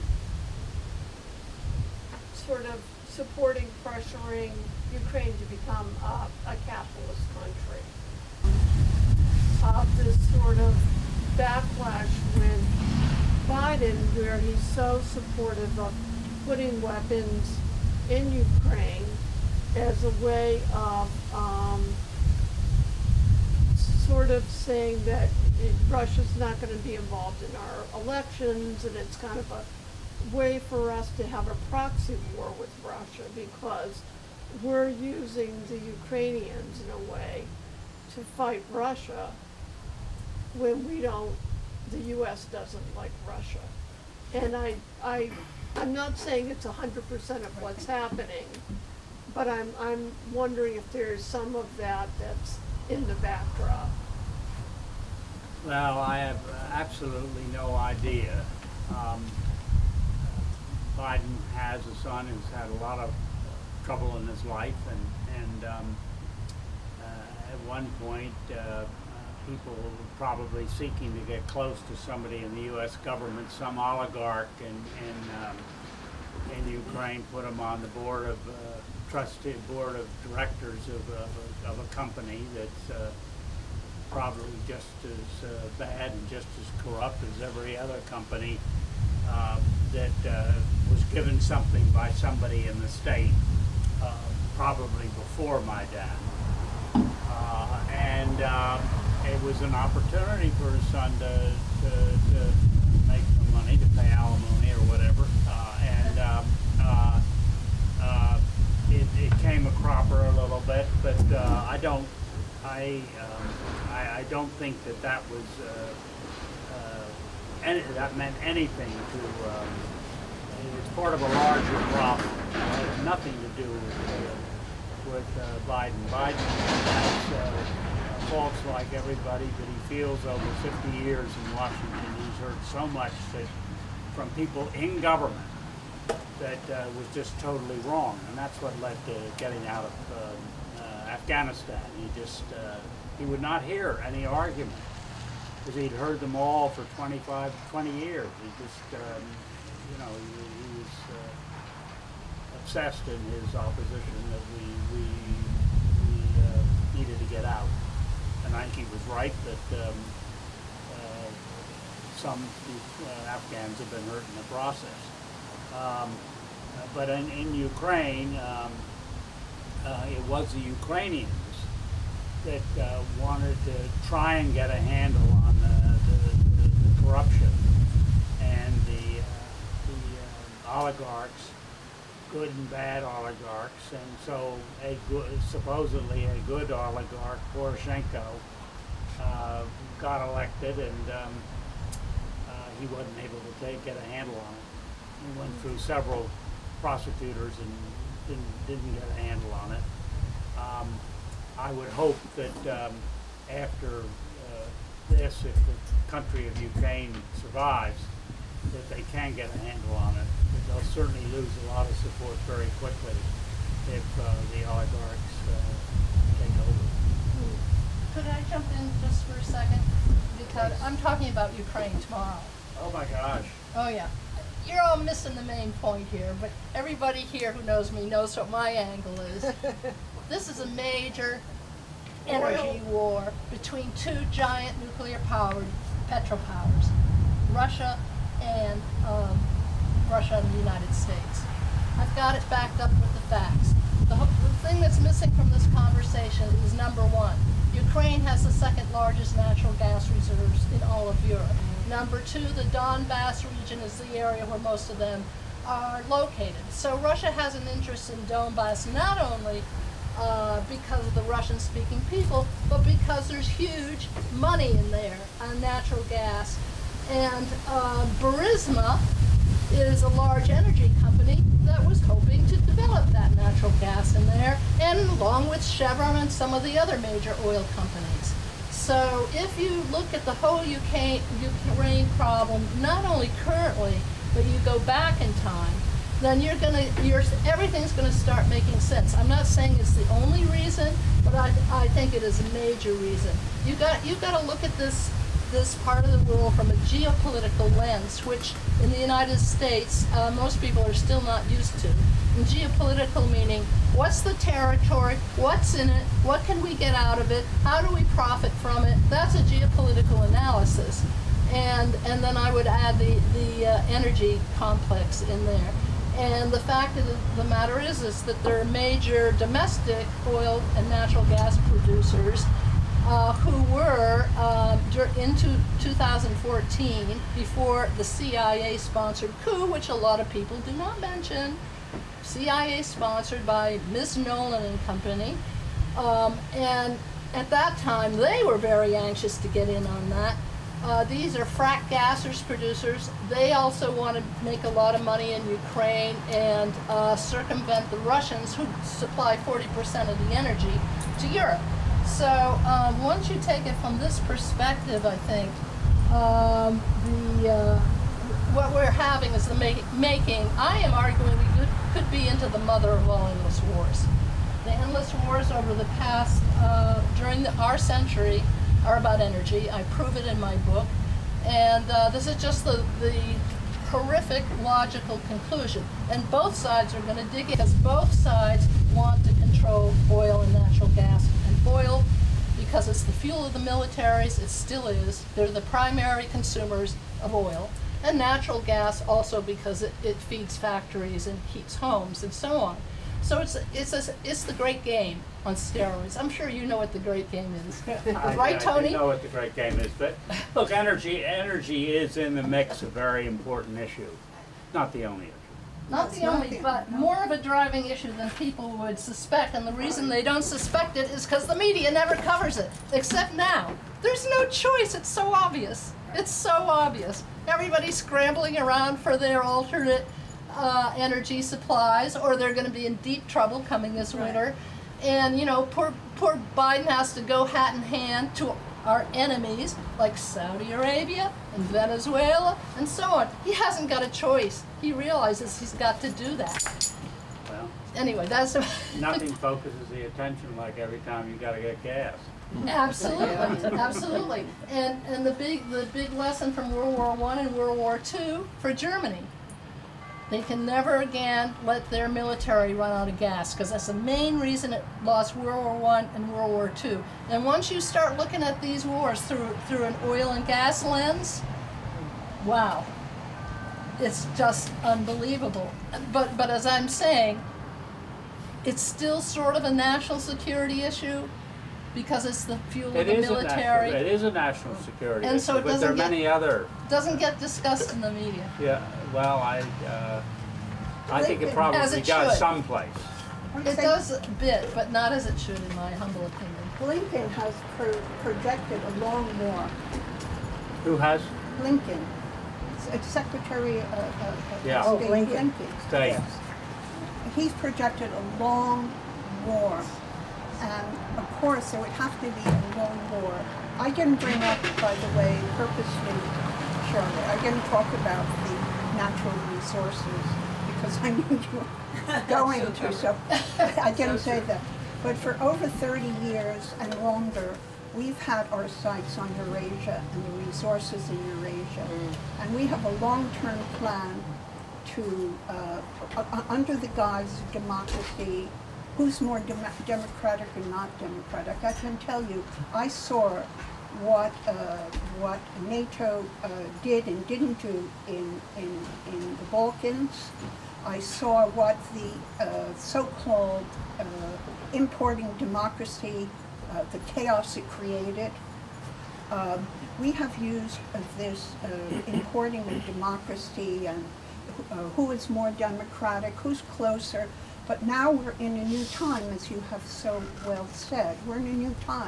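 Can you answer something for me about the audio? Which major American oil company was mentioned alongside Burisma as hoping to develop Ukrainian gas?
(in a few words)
Chevron.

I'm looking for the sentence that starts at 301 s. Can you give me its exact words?
And geopolitical meaning what's the territory, what's in it, what can we get out of it, how do we profit from it?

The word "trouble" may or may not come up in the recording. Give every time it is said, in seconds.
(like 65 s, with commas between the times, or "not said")
63 s, 423 s.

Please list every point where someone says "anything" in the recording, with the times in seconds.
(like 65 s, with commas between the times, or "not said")
118 s.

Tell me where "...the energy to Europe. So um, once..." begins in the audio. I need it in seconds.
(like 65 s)
350 s.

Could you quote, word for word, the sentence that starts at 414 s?
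There's no choice, it's so obvious.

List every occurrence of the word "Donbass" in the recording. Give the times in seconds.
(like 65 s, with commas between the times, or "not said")
252 s, 258 s.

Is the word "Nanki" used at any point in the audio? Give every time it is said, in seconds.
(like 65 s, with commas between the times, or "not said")
158 s.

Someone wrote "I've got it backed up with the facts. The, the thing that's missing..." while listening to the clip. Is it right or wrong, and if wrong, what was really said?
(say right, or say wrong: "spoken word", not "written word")
right.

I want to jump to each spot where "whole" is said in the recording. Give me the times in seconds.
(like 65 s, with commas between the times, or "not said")
280 s.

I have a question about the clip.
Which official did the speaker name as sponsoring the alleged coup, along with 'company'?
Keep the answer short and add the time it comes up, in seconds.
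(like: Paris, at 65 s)
Ms. Nuland, at 333 s.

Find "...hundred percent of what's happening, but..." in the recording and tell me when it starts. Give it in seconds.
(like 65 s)
46 s.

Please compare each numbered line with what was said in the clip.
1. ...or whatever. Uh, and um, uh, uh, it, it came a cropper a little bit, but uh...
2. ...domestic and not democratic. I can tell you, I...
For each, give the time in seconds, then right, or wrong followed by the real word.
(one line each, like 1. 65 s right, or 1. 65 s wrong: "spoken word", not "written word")
1. 104 s right
2. 529 s wrong: "democratic", not "domestic".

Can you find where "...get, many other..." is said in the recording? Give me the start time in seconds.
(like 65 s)
475 s.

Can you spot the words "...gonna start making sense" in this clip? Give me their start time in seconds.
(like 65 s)
287 s.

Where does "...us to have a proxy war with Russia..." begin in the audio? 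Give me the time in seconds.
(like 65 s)
30 s.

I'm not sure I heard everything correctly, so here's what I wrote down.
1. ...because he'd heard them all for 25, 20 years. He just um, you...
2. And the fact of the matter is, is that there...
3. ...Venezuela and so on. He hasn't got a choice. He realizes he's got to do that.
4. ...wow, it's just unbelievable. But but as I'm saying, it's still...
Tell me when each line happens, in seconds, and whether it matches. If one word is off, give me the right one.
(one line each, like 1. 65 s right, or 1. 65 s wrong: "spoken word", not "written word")
1. 145 s right
2. 316 s right
3. 431 s right
4. 462 s right.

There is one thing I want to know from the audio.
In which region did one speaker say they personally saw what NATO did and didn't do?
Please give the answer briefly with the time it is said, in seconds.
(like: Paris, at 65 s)
The Balkans, at 539 s.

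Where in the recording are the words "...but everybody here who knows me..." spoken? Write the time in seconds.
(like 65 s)
226 s.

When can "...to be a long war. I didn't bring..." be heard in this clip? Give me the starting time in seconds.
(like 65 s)
502 s.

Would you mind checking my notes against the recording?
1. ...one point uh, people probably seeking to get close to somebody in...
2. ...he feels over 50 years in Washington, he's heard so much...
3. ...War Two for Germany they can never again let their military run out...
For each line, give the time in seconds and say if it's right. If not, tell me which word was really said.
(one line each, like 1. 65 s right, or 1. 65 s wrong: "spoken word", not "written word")
1. 67 s right
2. 129 s right
3. 447 s right.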